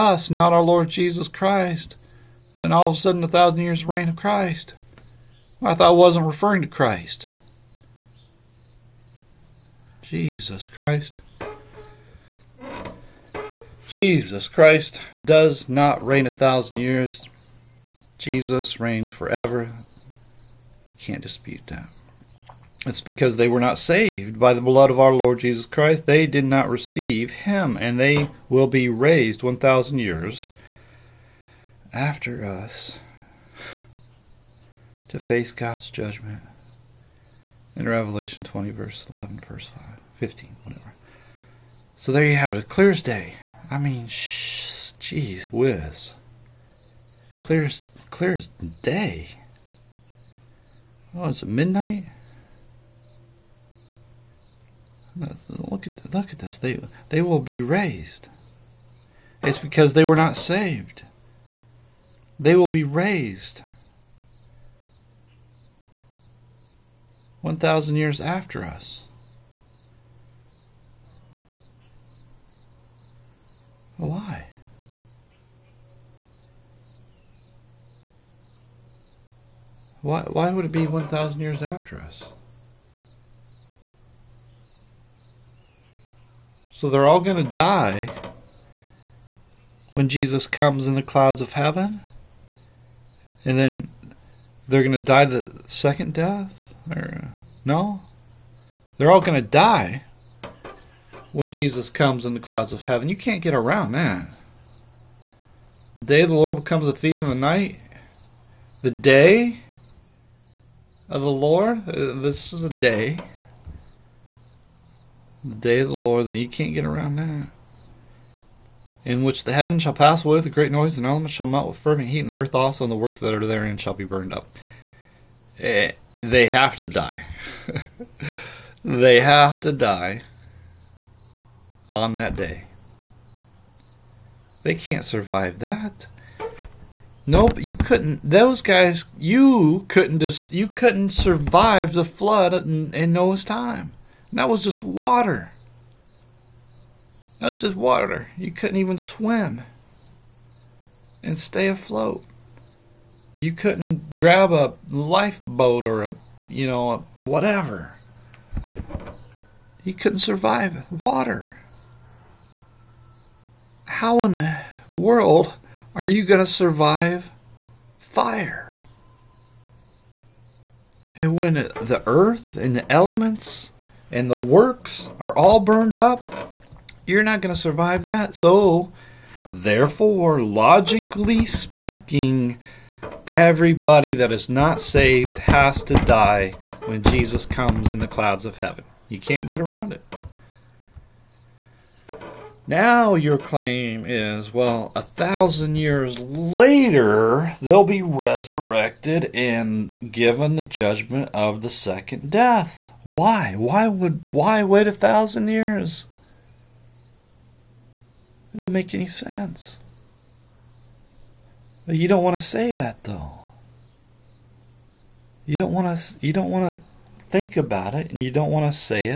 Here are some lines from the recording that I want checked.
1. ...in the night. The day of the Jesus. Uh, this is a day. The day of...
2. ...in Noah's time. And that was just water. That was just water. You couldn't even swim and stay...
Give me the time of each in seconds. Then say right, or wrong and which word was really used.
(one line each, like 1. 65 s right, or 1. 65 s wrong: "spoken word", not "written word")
1. 107 s wrong: "Lord", not "Jesus"
2. 142 s right.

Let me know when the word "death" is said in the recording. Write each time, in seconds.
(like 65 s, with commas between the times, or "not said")
96 s, 202 s.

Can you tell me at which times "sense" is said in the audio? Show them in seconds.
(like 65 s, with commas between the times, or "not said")
209 s.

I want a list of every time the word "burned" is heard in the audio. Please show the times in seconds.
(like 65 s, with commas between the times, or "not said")
124 s, 175 s.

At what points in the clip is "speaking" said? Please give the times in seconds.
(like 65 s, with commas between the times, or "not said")
181 s.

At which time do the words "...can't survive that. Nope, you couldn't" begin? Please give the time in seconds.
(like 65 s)
134 s.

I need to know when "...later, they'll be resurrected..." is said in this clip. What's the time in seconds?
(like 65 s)
196 s.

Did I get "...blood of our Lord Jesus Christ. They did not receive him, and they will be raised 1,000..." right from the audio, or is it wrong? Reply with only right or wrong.
right.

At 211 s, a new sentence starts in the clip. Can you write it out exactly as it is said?
But you don't want to say that though.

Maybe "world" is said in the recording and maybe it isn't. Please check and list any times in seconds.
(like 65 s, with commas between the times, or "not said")
164 s.